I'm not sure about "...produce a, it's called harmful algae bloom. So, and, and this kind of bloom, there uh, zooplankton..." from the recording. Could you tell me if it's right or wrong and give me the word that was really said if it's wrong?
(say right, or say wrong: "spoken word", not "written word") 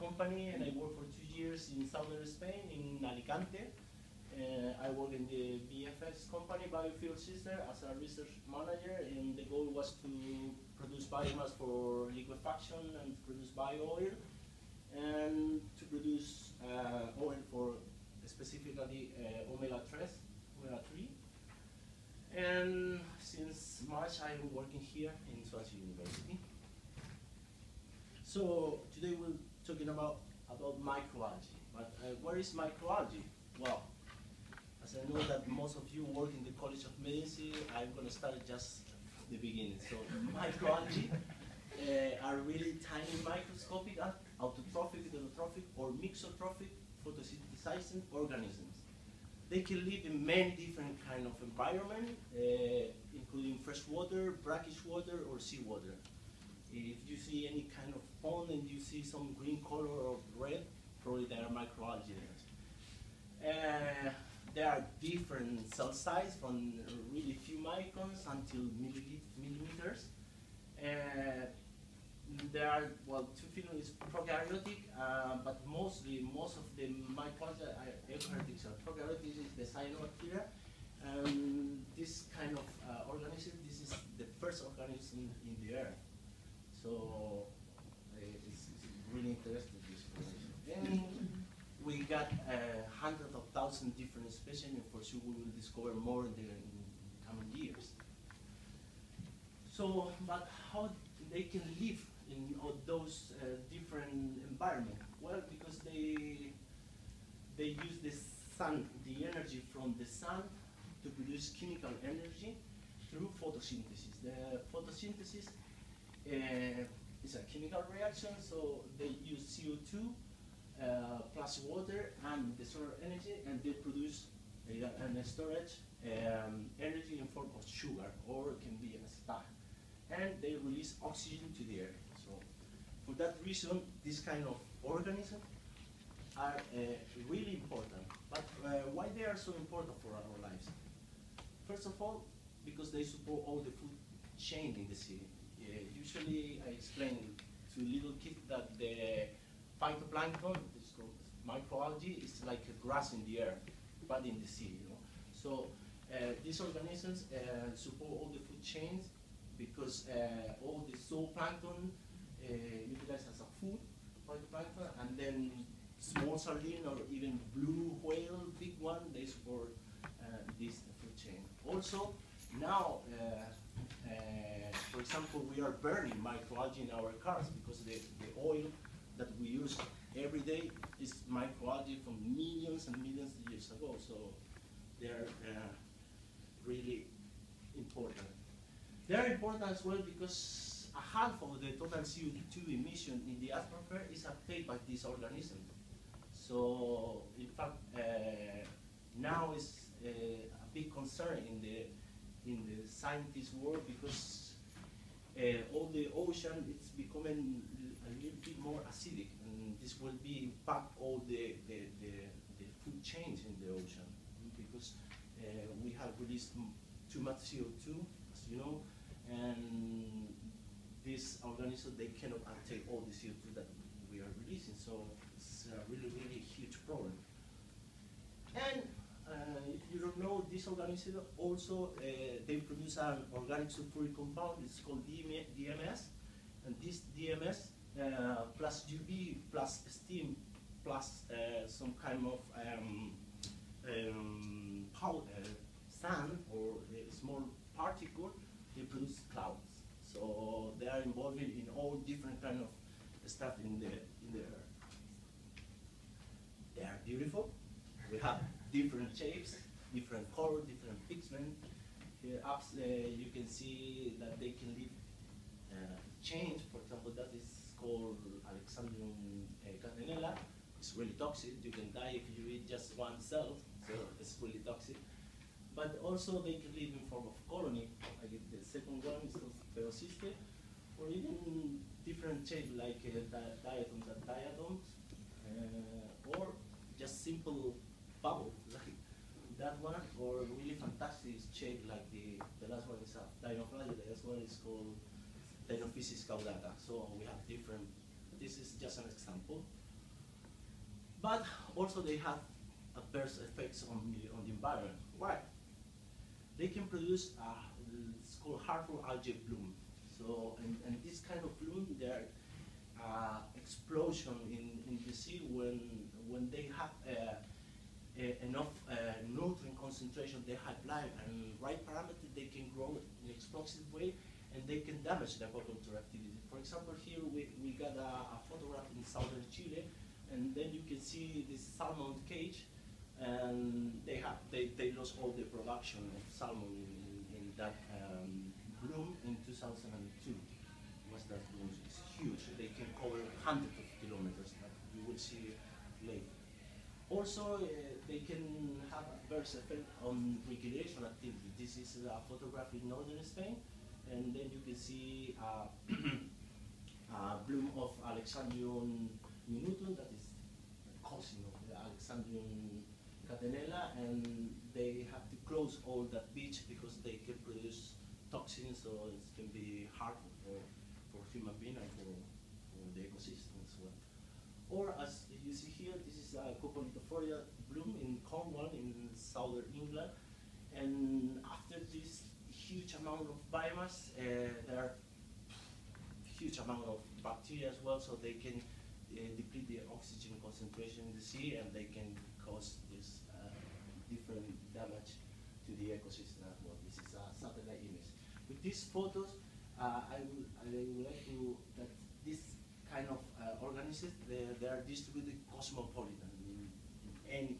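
wrong: "explosion", not "zooplankton".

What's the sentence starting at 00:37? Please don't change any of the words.
I'm going to start just the beginning.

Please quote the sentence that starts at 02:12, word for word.
So for that reason, this kind of organism are uh, really important.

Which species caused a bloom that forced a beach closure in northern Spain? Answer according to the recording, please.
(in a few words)
Alexandrium minutum.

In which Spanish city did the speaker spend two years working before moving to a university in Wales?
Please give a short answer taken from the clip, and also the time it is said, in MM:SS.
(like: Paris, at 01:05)
Alicante, at 00:03.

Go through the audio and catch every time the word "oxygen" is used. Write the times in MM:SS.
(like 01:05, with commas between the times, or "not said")
02:11, 06:29.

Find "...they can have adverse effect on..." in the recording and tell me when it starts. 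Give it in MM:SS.
05:48.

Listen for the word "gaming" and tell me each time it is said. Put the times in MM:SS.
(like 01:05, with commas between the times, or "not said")
not said.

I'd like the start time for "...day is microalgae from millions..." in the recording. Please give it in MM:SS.
03:00.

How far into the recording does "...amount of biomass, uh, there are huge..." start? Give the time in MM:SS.
06:22.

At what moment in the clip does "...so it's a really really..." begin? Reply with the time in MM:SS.
03:44.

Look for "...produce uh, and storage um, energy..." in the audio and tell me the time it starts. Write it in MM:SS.
02:03.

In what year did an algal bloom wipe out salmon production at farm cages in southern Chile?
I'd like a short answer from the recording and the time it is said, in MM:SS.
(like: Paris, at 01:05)
2002, at 05:39.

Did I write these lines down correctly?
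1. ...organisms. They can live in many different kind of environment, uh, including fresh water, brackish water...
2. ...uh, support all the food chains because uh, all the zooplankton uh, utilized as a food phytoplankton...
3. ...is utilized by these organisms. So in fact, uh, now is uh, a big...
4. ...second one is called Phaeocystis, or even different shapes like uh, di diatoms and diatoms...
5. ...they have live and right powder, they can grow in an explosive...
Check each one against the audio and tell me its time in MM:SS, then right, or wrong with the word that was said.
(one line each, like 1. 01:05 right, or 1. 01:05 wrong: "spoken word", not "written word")
1. 00:48 right
2. 02:37 right
3. 03:14 wrong: "absorbed", not "utilized"
4. 04:38 right
5. 05:20 wrong: "parameter", not "powder".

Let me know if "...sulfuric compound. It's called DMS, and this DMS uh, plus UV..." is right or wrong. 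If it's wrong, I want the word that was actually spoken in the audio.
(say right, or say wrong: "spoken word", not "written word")
right.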